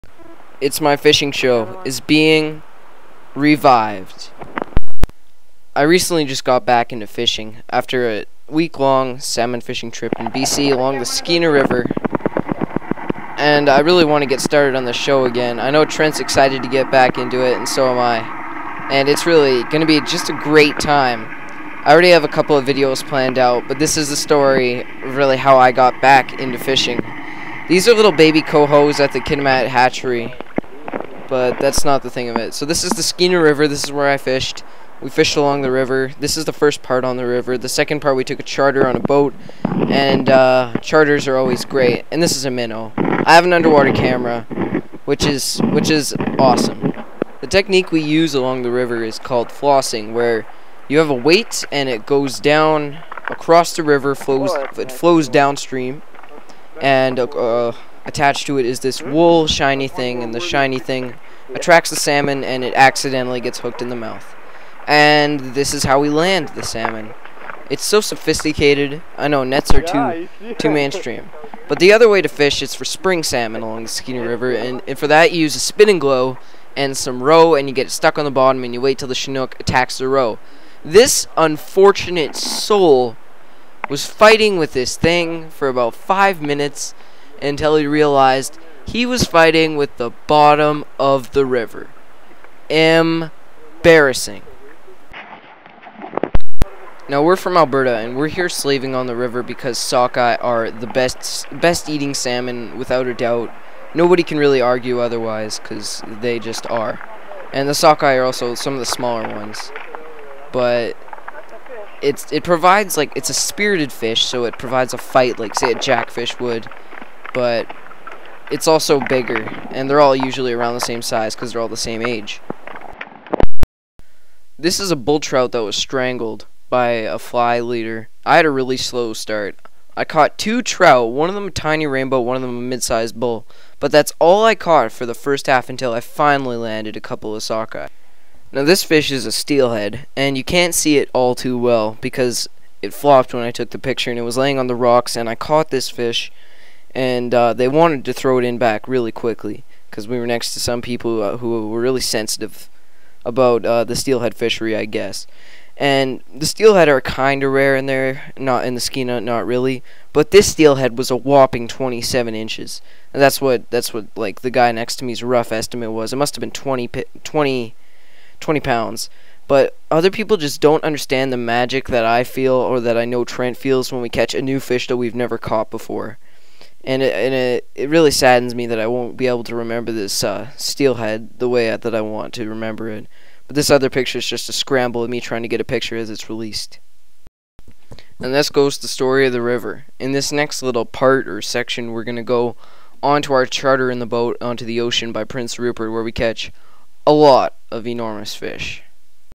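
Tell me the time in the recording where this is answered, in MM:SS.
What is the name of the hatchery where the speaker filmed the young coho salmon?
00:29.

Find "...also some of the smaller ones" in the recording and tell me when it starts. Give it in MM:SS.
01:48.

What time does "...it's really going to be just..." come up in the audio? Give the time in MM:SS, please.
00:19.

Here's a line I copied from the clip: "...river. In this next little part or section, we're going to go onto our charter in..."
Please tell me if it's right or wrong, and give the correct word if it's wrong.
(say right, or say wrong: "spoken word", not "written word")
right.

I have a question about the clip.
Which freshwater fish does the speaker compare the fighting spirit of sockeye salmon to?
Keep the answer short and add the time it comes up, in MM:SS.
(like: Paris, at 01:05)
Jackfish, at 01:55.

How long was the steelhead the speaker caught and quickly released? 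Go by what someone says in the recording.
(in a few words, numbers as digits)
27 inches.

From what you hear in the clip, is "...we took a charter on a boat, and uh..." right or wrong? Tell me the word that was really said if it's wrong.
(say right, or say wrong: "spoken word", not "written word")
right.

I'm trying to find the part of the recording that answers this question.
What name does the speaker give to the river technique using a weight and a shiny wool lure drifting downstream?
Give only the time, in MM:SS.
00:49.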